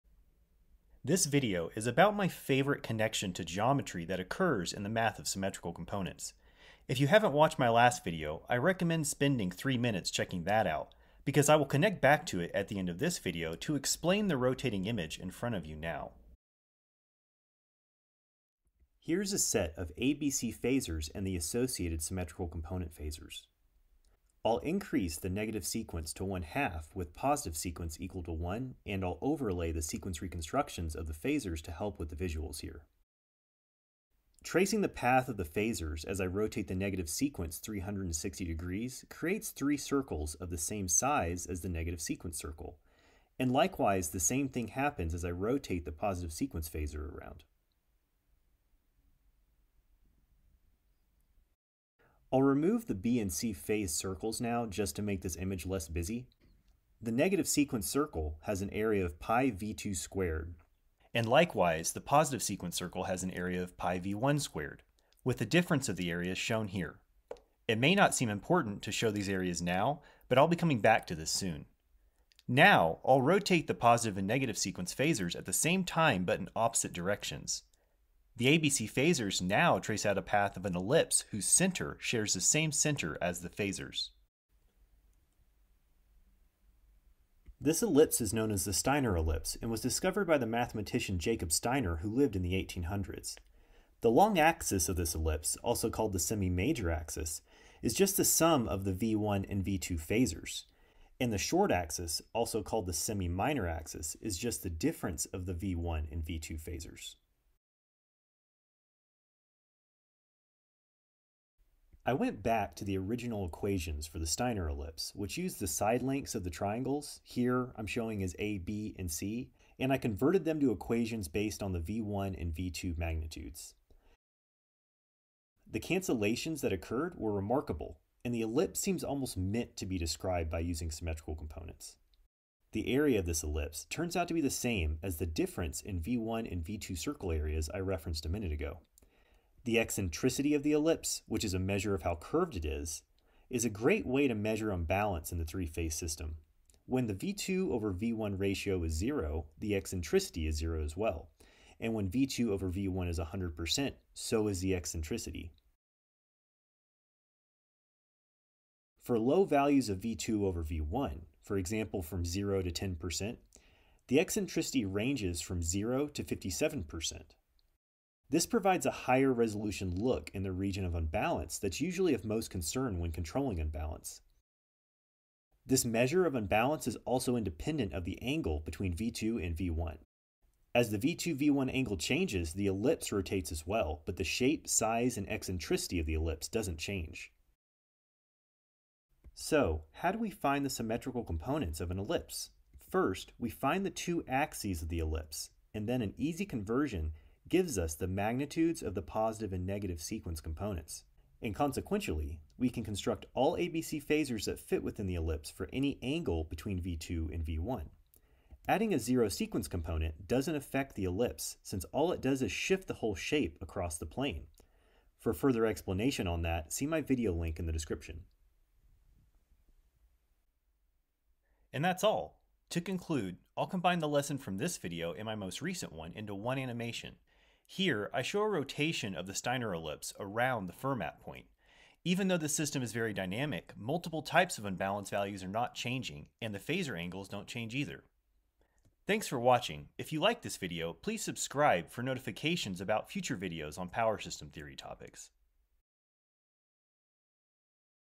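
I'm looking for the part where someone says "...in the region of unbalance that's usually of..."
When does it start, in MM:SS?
02:50.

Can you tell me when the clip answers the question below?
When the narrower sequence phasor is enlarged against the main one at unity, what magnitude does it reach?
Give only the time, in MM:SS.
00:26.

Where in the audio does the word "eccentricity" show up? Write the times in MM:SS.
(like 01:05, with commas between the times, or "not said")
02:19, 02:29, 02:34, 02:44, 03:05.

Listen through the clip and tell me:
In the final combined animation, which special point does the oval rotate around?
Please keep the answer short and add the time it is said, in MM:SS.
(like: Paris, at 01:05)
Fermat point, at 03:50.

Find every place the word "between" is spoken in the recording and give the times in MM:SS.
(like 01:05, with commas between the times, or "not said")
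02:58, 03:26.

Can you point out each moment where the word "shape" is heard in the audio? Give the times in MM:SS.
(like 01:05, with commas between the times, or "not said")
03:04, 03:33.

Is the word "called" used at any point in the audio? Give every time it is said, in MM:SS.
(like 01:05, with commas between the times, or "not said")
01:35, 01:42.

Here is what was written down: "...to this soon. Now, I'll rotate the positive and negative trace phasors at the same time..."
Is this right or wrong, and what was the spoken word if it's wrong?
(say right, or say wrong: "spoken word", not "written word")
wrong: "sequence", not "trace".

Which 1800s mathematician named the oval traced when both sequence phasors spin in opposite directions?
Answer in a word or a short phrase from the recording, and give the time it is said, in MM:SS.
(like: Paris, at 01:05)
Jacob Steiner, at 01:31.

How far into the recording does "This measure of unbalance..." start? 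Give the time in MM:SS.
02:55.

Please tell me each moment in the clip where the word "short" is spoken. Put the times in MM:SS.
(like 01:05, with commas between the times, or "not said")
01:41.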